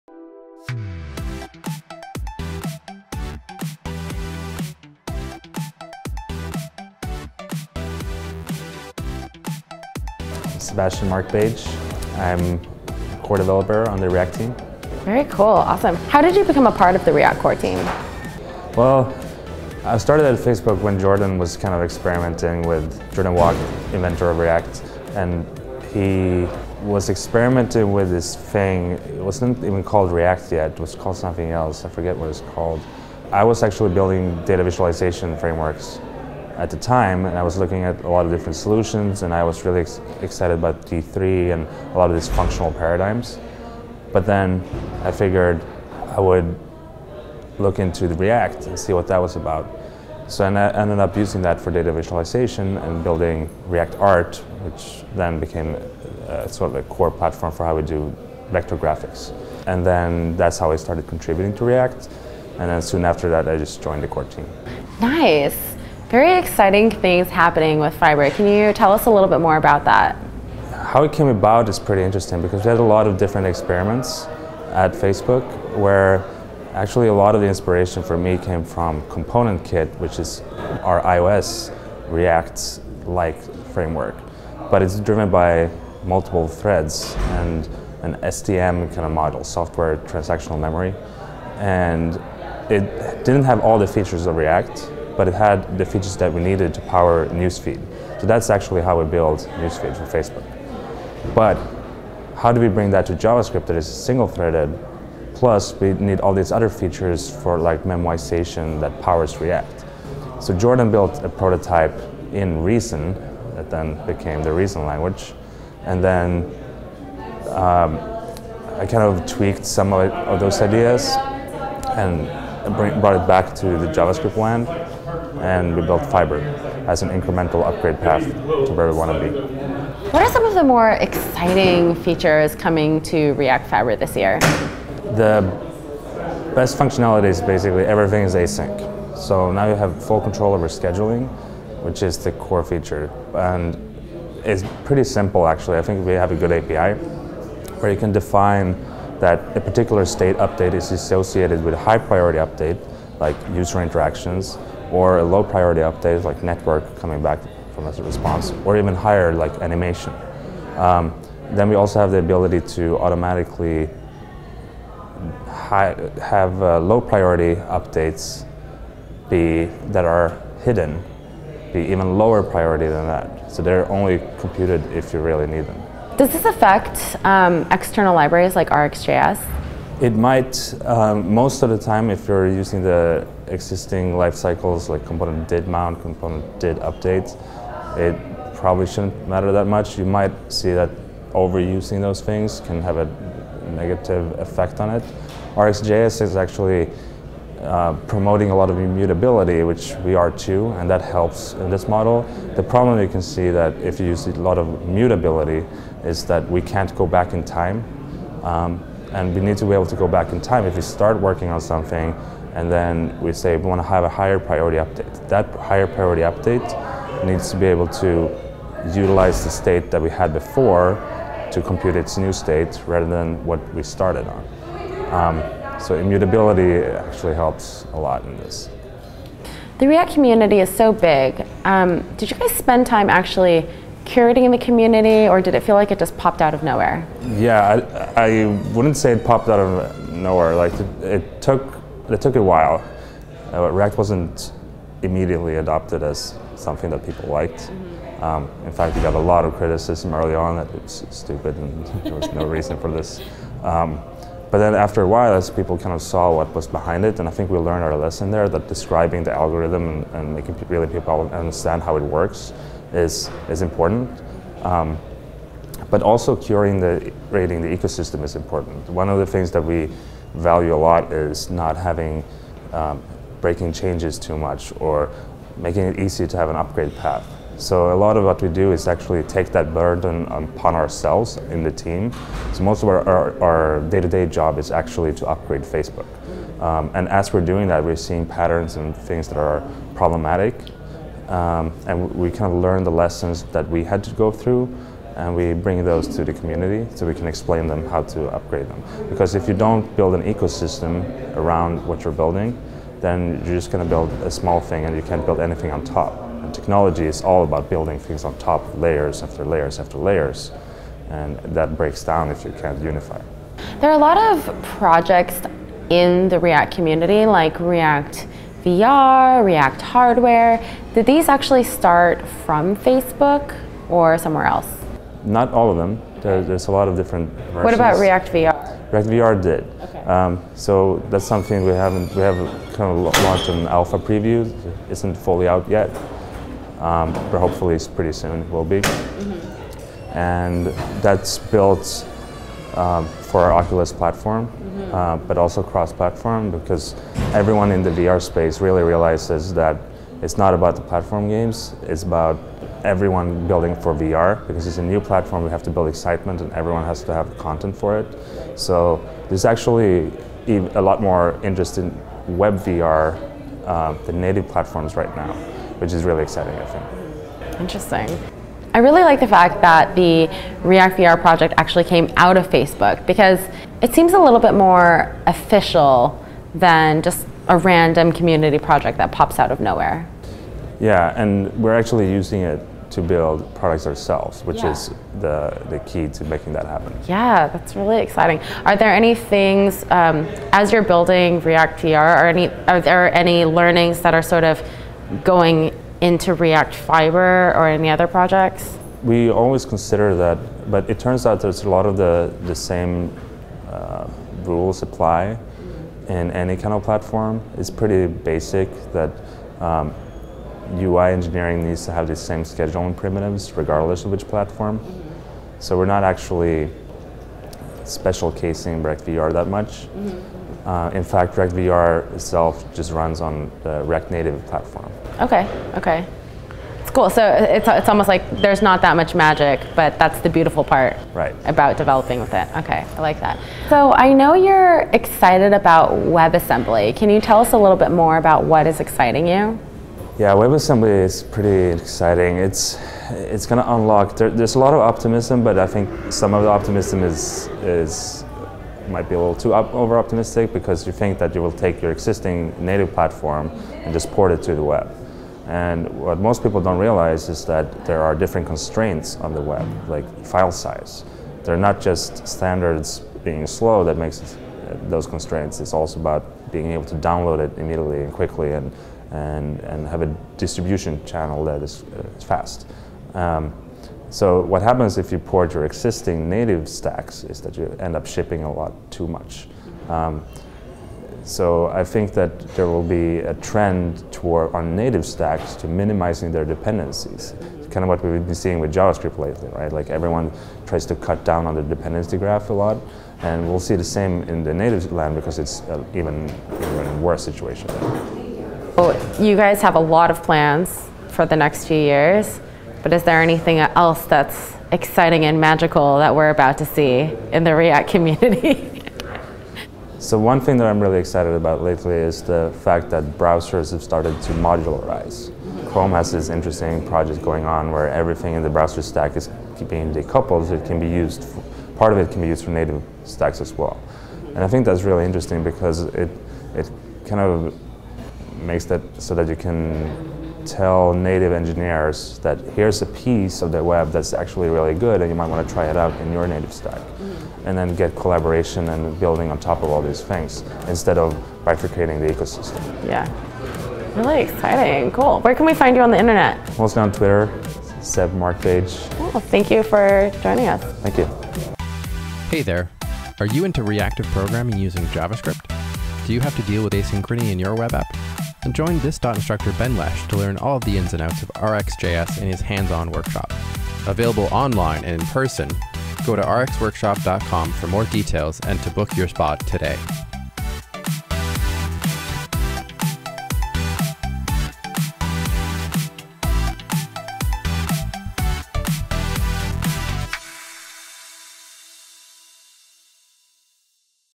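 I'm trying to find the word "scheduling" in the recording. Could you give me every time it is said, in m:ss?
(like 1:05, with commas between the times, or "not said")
2:20, 6:52.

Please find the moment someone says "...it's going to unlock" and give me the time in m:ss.
7:23.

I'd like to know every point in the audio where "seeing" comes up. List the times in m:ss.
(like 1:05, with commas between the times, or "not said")
4:48, 8:08.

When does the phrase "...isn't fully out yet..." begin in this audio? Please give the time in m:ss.
5:34.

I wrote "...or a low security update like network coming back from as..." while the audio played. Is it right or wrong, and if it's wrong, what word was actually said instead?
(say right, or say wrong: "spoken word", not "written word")
wrong: "priority", not "security".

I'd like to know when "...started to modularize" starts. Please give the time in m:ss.
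8:33.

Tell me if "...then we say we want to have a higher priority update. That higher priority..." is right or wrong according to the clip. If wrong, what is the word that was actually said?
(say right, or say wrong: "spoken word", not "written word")
right.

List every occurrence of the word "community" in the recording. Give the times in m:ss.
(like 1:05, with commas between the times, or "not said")
3:50, 3:54, 4:56, 5:16, 6:18, 8:27.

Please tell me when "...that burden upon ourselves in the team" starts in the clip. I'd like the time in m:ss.
4:39.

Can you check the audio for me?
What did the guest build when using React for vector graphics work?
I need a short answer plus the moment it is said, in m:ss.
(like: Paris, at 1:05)
React Art, at 0:53.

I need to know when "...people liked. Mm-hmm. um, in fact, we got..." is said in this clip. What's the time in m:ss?
4:07.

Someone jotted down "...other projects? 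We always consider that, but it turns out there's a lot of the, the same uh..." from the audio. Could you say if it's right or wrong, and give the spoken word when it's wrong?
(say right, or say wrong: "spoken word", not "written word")
right.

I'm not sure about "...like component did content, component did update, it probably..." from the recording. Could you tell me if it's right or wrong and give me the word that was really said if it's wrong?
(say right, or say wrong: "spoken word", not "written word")
wrong: "mount", not "content".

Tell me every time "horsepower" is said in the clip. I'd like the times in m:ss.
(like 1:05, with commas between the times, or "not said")
not said.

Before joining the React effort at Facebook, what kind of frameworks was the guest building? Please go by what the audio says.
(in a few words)
Data visualization frameworks.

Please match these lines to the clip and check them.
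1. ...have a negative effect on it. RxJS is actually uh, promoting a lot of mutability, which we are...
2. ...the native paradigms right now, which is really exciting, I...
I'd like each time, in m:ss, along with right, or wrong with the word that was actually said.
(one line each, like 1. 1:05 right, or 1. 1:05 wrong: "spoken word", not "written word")
1. 3:12 wrong: "immutability", not "mutability"
2. 6:04 wrong: "platforms", not "paradigms".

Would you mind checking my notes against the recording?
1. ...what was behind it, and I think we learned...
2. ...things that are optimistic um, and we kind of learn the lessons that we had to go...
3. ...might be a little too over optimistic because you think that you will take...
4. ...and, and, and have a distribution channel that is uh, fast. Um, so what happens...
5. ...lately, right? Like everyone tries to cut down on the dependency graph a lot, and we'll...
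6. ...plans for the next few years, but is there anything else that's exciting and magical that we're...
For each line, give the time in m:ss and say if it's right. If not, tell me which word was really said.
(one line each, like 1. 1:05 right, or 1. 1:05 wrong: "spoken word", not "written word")
1. 4:16 right
2. 4:48 wrong: "problematic", not "optimistic"
3. 7:28 right
4. 7:48 right
5. 8:09 right
6. 8:20 right.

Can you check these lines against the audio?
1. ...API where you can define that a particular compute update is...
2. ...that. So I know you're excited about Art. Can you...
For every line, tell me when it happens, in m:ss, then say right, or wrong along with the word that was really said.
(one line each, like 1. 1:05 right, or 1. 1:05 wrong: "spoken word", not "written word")
1. 2:26 wrong: "state", not "compute"
2. 7:13 wrong: "WebAssembly", not "Art".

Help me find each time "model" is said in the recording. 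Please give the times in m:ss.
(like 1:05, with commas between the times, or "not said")
1:29, 3:21.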